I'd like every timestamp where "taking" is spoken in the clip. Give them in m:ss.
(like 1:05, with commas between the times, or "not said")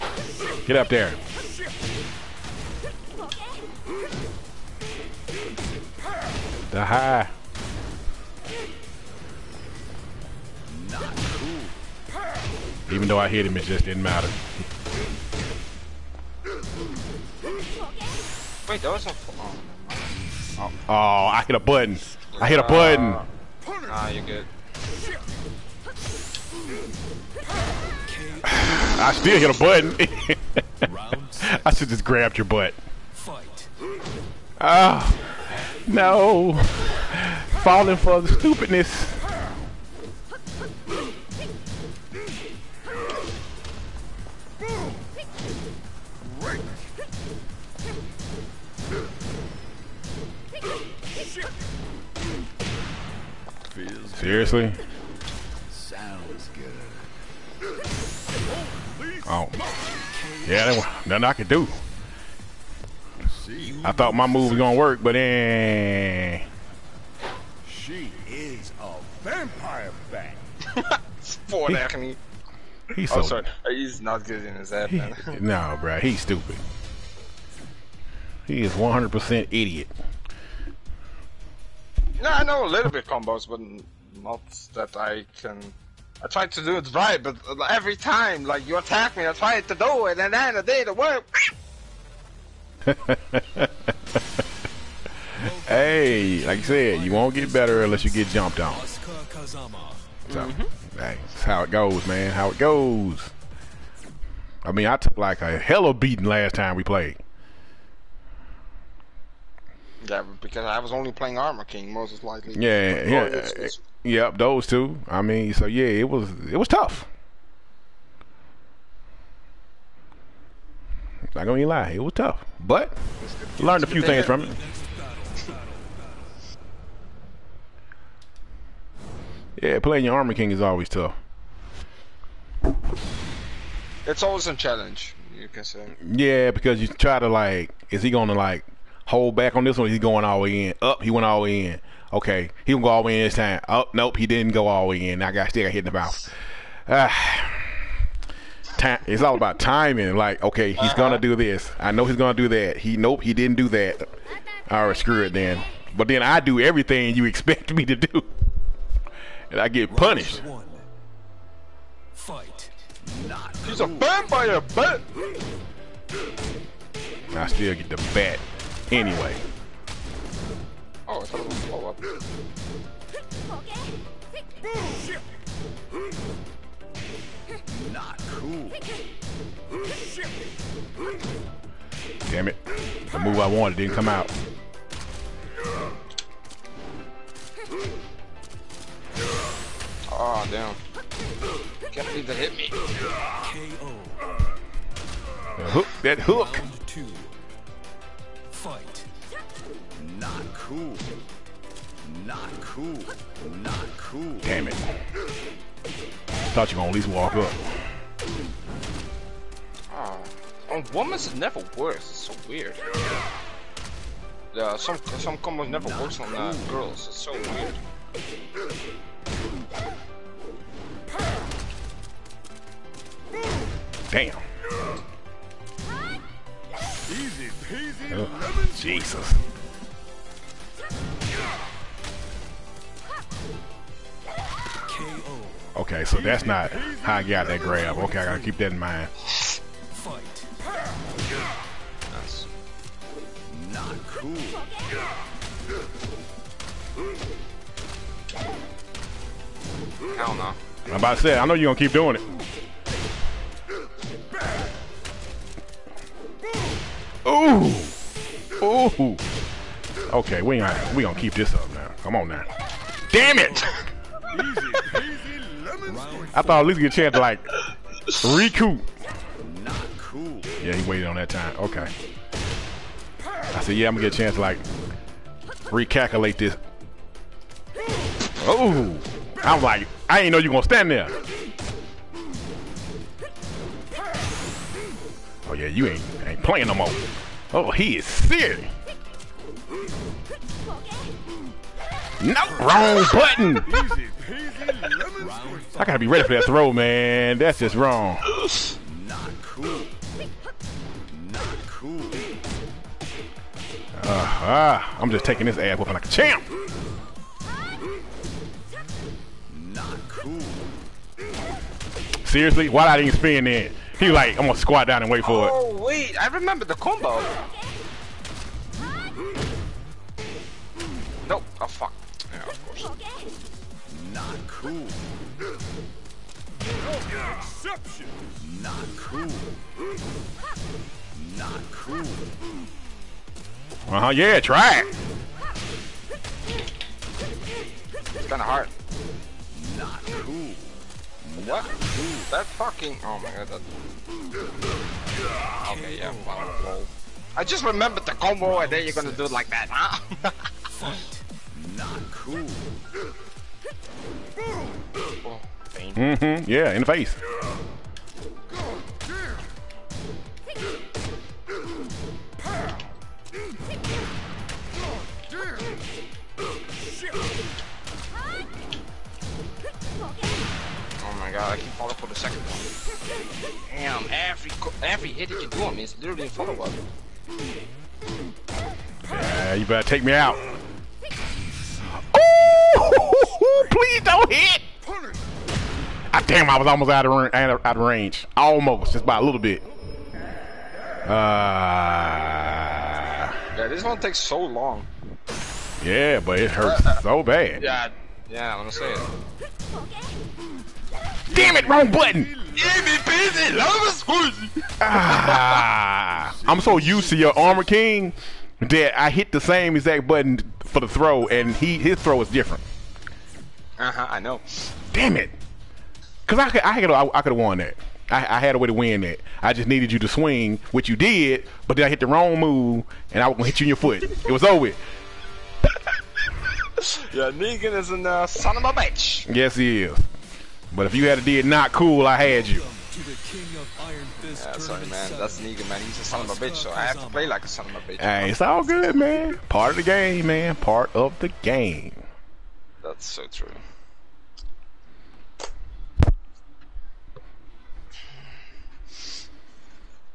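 5:05.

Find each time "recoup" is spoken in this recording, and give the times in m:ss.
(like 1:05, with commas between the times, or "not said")
4:28.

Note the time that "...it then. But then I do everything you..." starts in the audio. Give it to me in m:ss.
2:35.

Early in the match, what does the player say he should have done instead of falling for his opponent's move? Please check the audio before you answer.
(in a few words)
grabbed your butt.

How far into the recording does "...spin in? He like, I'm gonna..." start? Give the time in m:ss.
5:13.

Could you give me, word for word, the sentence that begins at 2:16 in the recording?
Yeah, because you try to like, is he gonna like Hold back on this one.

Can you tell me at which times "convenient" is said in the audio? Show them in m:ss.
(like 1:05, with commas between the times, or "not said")
not said.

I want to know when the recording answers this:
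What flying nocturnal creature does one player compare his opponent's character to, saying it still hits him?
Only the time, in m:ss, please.
1:09.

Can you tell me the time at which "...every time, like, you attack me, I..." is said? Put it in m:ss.
1:27.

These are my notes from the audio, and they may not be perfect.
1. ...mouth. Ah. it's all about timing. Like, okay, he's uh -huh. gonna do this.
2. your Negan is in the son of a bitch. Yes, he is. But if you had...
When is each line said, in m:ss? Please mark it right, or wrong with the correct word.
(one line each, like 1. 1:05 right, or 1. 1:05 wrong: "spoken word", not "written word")
1. 2:25 right
2. 7:04 right.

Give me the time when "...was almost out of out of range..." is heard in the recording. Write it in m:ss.
6:26.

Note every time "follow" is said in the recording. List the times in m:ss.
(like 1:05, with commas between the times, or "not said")
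6:16.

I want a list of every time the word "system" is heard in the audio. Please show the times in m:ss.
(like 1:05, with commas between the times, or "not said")
not said.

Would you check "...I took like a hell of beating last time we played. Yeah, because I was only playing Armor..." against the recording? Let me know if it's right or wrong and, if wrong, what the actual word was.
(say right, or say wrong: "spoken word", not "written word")
right.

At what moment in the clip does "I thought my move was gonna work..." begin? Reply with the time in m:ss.
1:03.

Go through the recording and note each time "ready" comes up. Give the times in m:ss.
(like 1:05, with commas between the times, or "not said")
4:56.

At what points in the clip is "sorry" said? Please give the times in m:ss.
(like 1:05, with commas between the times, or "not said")
1:13, 7:14.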